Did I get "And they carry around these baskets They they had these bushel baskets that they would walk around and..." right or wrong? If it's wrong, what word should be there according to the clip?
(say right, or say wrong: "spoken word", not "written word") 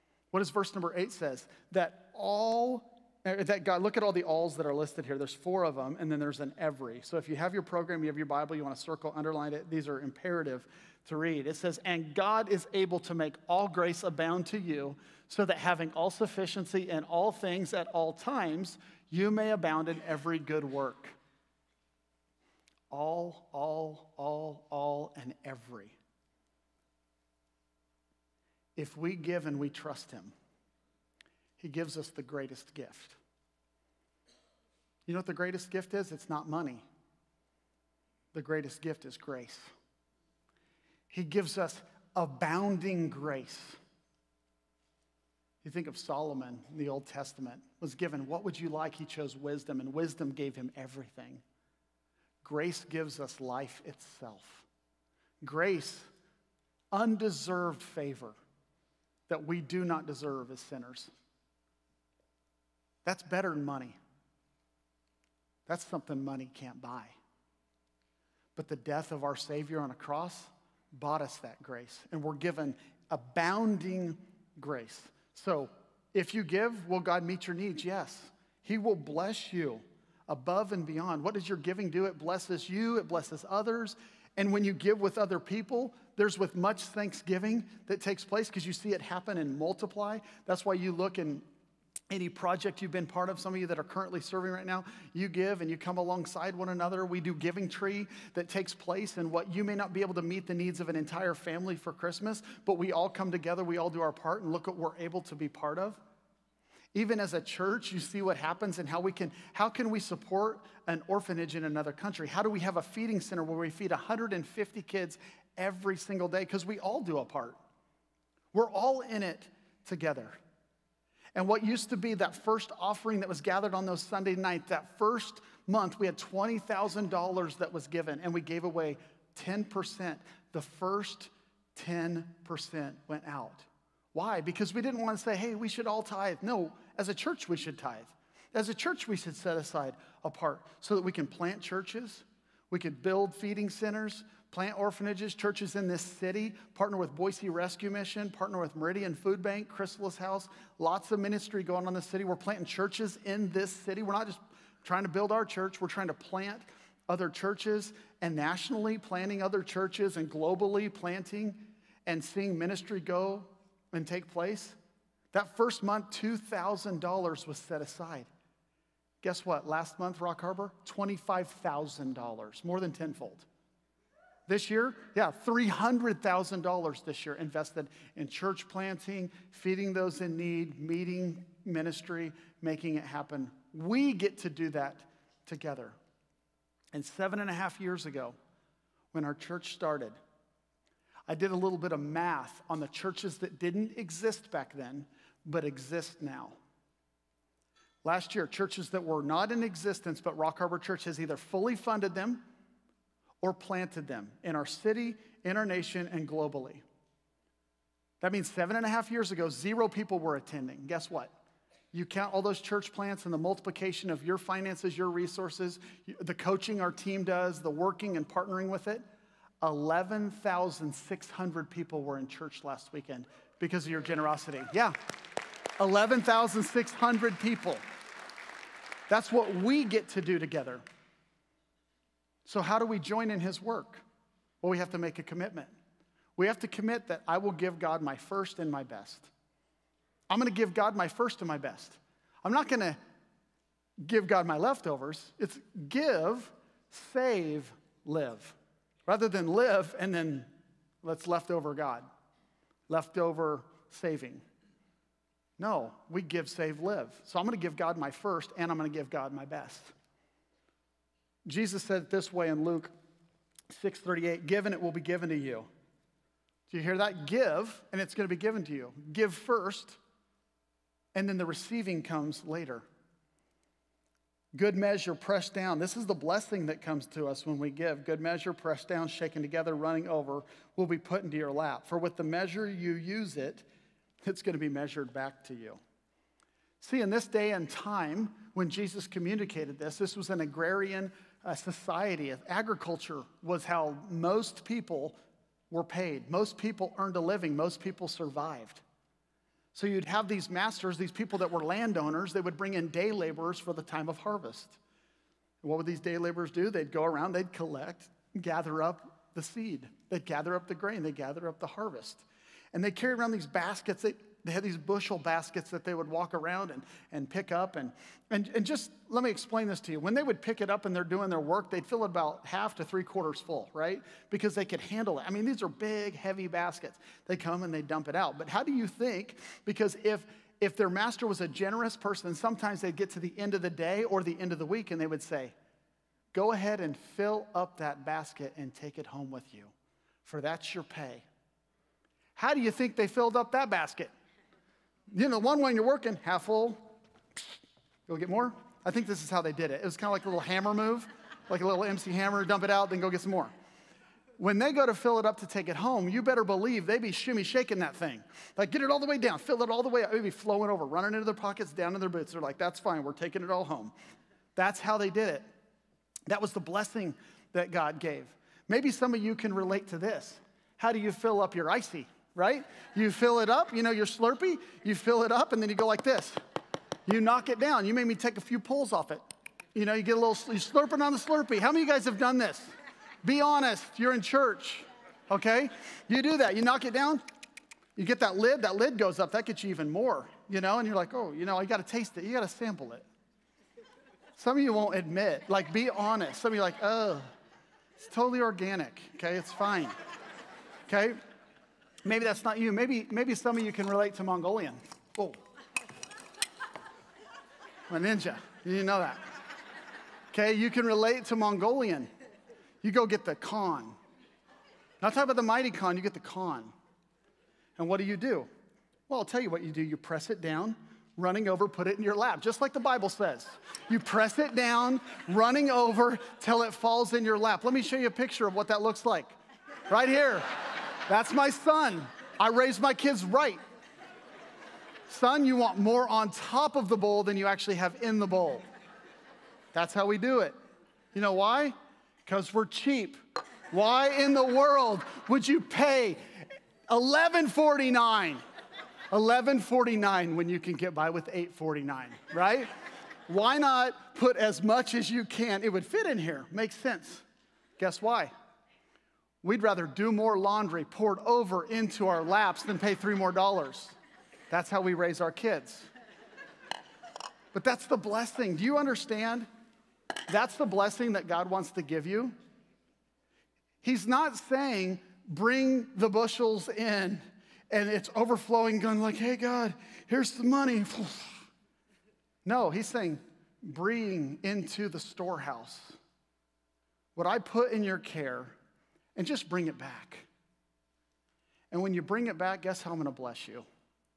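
right.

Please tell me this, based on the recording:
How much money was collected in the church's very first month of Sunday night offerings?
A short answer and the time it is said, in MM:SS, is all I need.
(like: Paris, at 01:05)
$20,000, at 02:06.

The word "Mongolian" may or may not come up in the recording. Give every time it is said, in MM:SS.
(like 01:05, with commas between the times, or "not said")
06:44, 06:51.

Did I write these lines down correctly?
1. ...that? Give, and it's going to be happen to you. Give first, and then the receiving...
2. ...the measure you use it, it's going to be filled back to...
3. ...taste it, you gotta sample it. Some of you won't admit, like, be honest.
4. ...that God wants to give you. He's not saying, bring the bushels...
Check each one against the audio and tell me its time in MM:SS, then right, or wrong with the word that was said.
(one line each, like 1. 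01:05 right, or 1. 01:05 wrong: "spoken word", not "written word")
1. 04:26 wrong: "given", not "happen"
2. 04:42 wrong: "measured", not "filled"
3. 06:31 right
4. 07:51 right.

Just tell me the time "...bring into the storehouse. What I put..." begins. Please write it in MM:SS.
08:03.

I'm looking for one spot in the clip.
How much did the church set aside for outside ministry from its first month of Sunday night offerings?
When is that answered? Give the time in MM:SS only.
02:46.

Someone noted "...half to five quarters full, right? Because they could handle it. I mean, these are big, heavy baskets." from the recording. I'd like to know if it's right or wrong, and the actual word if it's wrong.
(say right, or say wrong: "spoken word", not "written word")
wrong: "three", not "five".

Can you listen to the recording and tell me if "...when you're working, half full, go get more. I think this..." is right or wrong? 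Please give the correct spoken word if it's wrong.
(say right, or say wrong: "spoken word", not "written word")
right.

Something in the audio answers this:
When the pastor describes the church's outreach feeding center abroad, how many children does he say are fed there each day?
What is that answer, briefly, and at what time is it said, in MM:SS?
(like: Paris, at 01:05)
150, at 01:53.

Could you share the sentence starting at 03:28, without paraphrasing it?
That means seven and a half years ago, zero people were attending.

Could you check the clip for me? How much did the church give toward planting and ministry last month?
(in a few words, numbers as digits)
$25,000.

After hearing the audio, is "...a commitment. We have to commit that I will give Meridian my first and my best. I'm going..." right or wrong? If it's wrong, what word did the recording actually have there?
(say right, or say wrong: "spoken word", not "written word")
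wrong: "God", not "Meridian".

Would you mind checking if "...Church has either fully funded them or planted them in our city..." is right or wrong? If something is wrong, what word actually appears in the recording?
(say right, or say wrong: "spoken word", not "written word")
right.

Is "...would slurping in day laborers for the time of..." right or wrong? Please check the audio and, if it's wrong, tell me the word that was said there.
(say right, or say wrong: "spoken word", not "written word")
wrong: "bring", not "slurping".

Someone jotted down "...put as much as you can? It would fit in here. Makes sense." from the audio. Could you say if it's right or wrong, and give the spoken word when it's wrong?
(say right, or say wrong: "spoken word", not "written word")
right.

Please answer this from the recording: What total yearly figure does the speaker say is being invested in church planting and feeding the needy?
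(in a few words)
$300,000.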